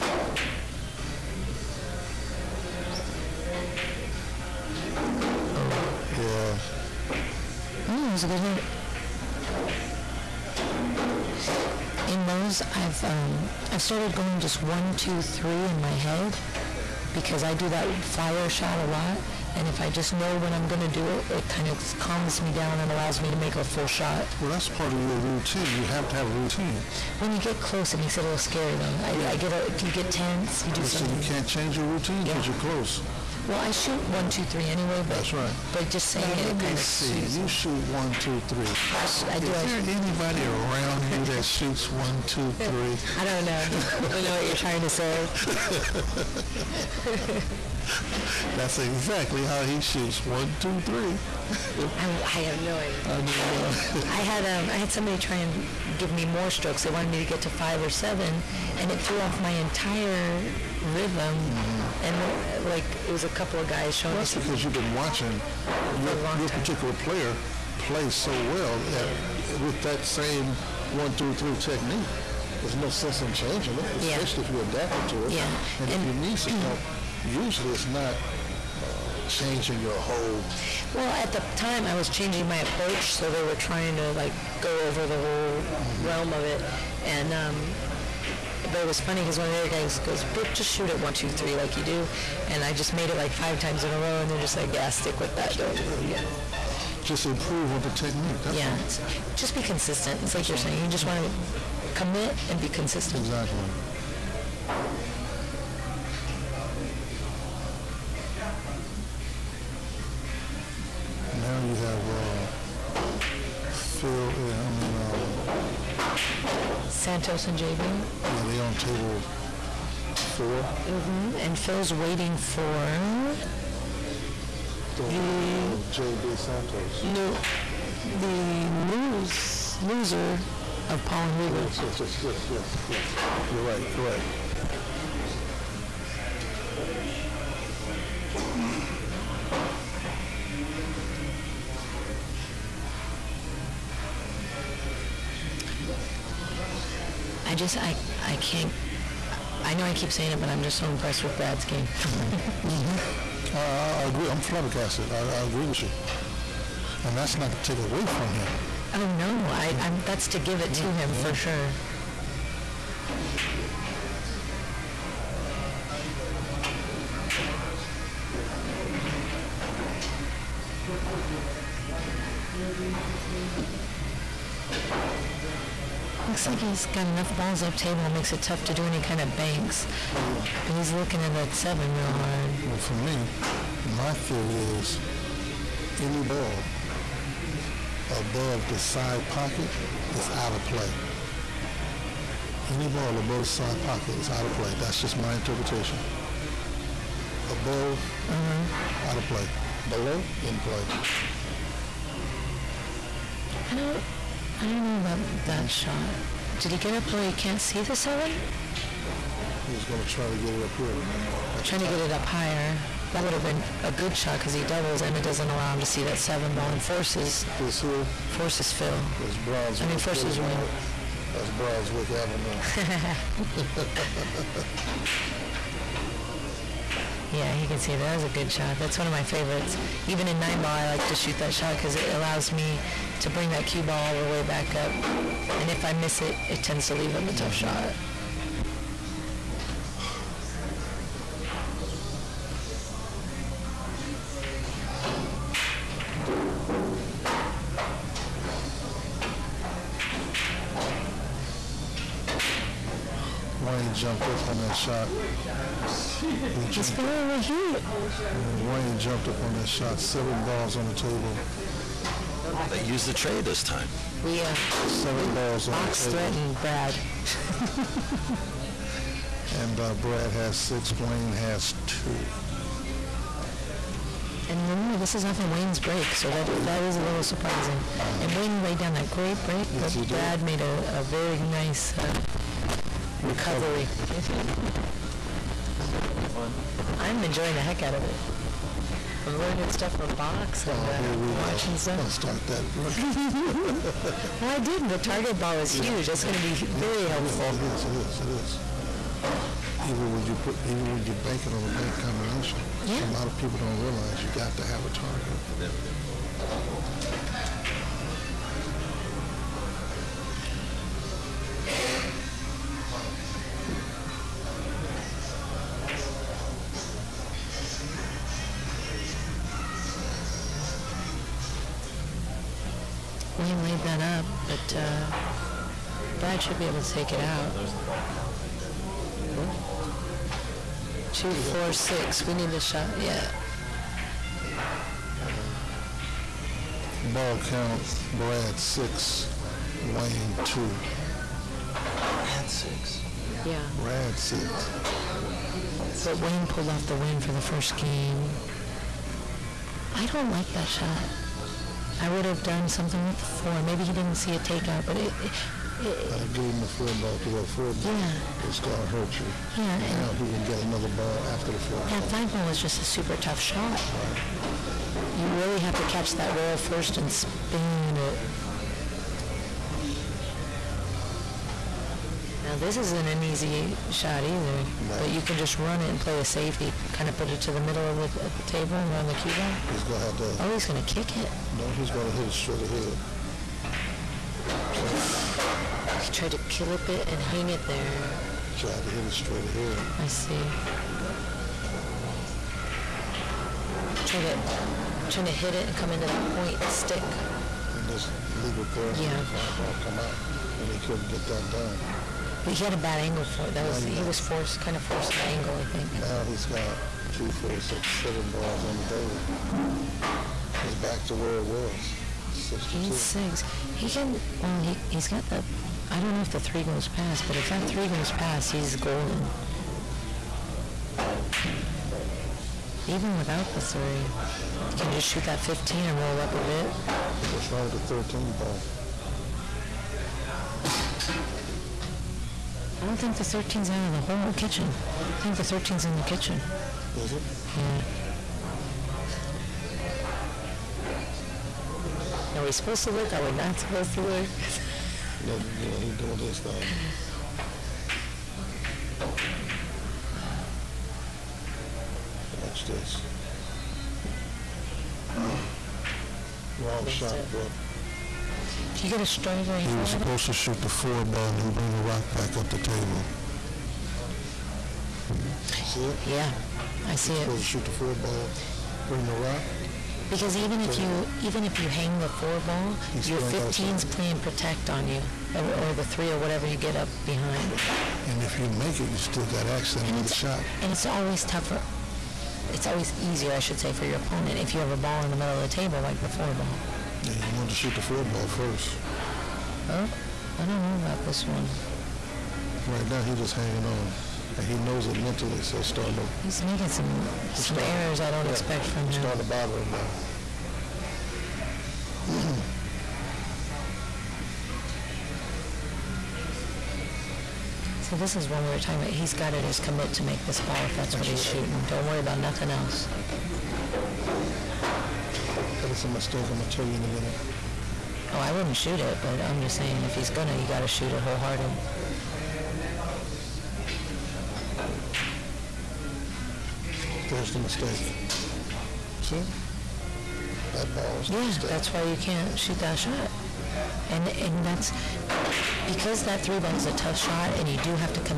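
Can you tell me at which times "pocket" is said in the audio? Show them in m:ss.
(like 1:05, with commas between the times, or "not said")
3:09, 3:13.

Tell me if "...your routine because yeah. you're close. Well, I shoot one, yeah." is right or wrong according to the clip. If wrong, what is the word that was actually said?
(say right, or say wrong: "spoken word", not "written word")
right.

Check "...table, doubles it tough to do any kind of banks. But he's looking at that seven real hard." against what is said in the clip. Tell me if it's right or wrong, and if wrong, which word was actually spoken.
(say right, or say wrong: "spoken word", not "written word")
wrong: "makes", not "doubles".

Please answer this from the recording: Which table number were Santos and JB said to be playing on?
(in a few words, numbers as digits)
4.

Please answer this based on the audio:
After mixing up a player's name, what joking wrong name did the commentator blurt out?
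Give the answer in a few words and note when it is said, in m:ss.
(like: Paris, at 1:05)
Brunswick Avenue, at 3:41.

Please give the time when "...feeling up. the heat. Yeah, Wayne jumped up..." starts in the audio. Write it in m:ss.
4:16.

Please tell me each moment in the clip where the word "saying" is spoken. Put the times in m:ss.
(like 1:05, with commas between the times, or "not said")
0:36, 1:40, 2:30, 8:39.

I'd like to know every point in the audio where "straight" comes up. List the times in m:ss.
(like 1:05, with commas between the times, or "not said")
6:22, 6:29.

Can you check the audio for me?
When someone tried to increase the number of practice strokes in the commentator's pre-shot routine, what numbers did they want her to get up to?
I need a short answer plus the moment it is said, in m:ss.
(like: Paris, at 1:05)
5 or 7, at 0:57.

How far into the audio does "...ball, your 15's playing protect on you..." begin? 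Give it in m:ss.
7:52.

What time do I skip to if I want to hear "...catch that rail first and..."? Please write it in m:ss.
6:05.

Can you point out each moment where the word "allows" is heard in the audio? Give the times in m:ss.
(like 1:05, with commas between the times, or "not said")
0:22, 3:35, 3:52.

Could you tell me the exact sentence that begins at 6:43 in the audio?
That was he was forced, kind of forced an angle, I think.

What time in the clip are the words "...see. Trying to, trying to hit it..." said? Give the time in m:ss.
6:30.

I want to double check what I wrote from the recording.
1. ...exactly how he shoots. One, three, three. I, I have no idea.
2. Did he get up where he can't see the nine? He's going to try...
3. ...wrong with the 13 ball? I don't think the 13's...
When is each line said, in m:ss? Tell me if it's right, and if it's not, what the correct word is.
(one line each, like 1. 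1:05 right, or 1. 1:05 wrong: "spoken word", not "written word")
1. 0:48 wrong: "two", not "three"
2. 3:26 wrong: "seven", not "nine"
3. 7:07 right.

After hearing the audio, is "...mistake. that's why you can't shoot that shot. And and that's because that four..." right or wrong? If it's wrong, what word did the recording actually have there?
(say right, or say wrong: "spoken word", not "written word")
wrong: "three", not "four".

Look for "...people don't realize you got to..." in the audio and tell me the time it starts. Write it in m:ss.
5:03.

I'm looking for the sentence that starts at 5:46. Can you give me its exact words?
But Wayne pulled off the win for the first game.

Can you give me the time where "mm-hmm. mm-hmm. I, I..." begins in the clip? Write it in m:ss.
2:31.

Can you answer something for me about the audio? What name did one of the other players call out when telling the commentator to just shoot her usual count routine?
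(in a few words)
Brook.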